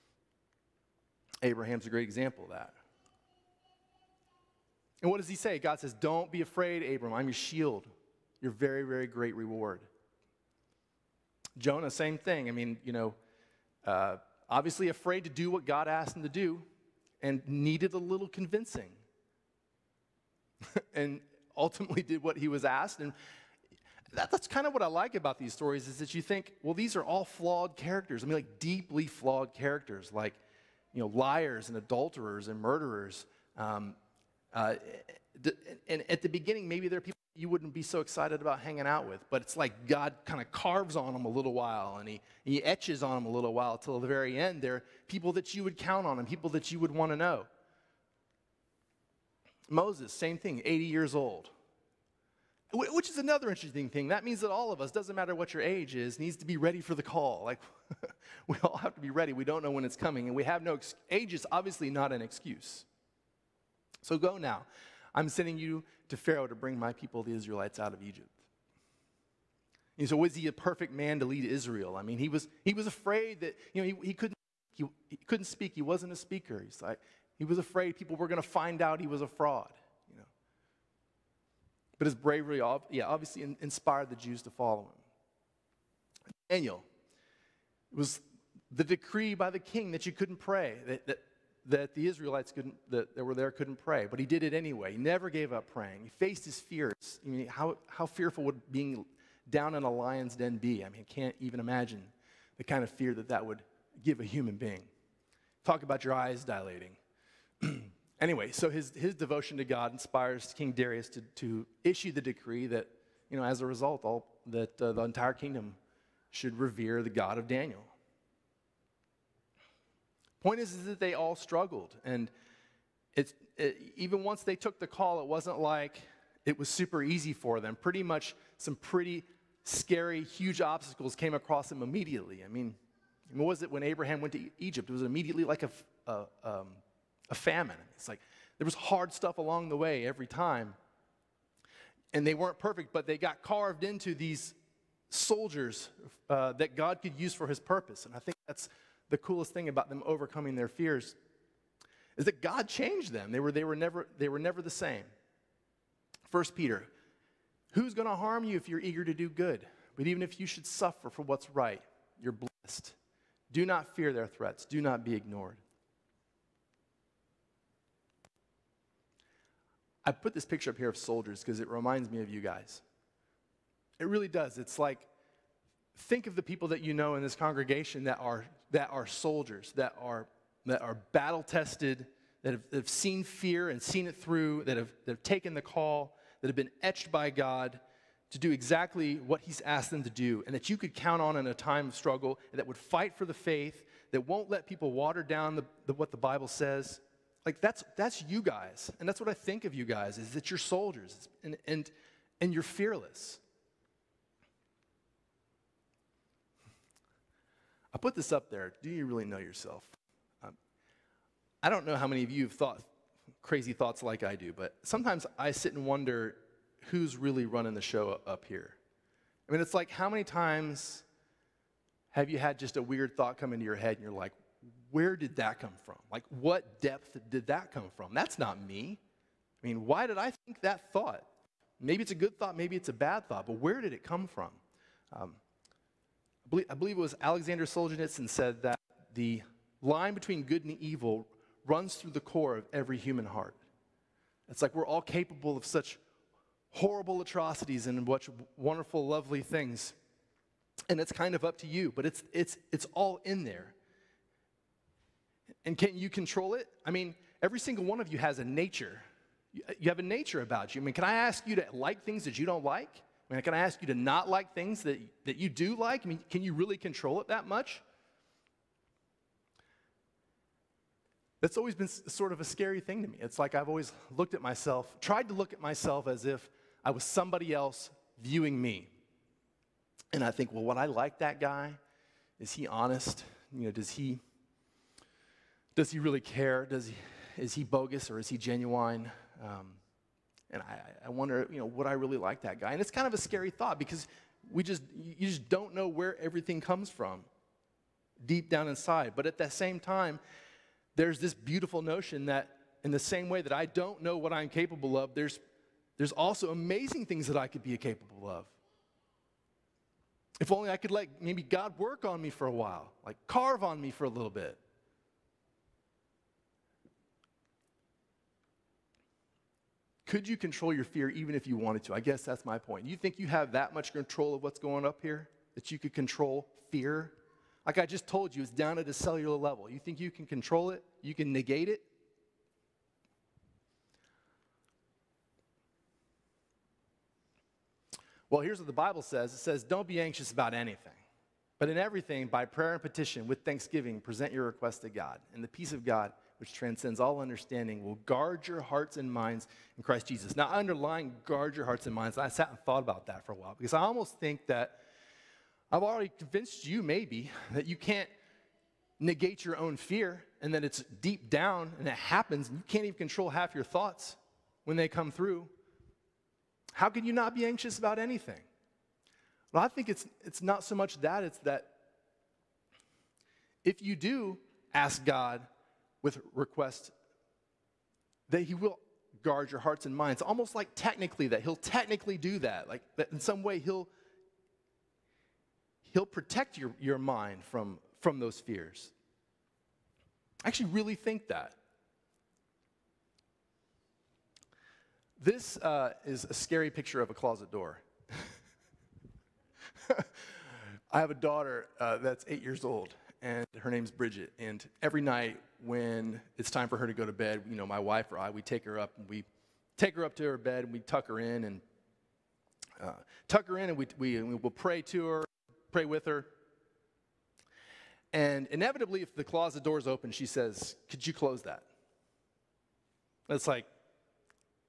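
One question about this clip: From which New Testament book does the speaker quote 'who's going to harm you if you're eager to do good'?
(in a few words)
First Peter.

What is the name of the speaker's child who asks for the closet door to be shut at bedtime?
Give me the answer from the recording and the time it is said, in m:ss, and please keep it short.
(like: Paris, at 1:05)
Bridget, at 6:43.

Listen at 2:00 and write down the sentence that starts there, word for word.
Point is, is that they all struggled.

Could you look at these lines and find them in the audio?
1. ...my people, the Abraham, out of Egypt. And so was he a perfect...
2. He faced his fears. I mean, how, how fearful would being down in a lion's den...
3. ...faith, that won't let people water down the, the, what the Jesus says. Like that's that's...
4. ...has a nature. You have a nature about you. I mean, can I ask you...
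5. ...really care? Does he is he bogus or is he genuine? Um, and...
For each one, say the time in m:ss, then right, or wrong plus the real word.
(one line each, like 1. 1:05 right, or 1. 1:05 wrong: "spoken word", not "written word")
1. 1:06 wrong: "Israelites", not "Abraham"
2. 1:36 right
3. 3:13 wrong: "Bible", not "Jesus"
4. 4:18 right
5. 4:45 right.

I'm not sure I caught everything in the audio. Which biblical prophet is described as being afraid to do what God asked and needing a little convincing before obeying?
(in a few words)
Jonah.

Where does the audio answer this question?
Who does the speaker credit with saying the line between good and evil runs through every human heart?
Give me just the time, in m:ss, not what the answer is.
3:57.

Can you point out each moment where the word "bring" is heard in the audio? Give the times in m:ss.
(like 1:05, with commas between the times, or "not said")
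1:06.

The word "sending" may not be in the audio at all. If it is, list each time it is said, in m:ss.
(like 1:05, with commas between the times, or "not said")
1:05.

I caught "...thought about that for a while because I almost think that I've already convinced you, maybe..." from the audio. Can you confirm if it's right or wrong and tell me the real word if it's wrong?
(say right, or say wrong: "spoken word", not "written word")
right.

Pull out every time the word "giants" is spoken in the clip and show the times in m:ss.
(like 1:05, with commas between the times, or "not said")
not said.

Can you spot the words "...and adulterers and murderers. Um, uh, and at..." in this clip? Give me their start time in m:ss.
0:31.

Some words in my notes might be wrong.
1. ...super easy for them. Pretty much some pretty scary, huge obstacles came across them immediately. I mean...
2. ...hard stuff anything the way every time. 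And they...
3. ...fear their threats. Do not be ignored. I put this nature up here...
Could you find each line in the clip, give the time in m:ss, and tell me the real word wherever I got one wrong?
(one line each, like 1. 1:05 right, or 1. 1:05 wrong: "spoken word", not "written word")
1. 2:06 right
2. 2:18 wrong: "along", not "anything"
3. 2:43 wrong: "picture", not "nature".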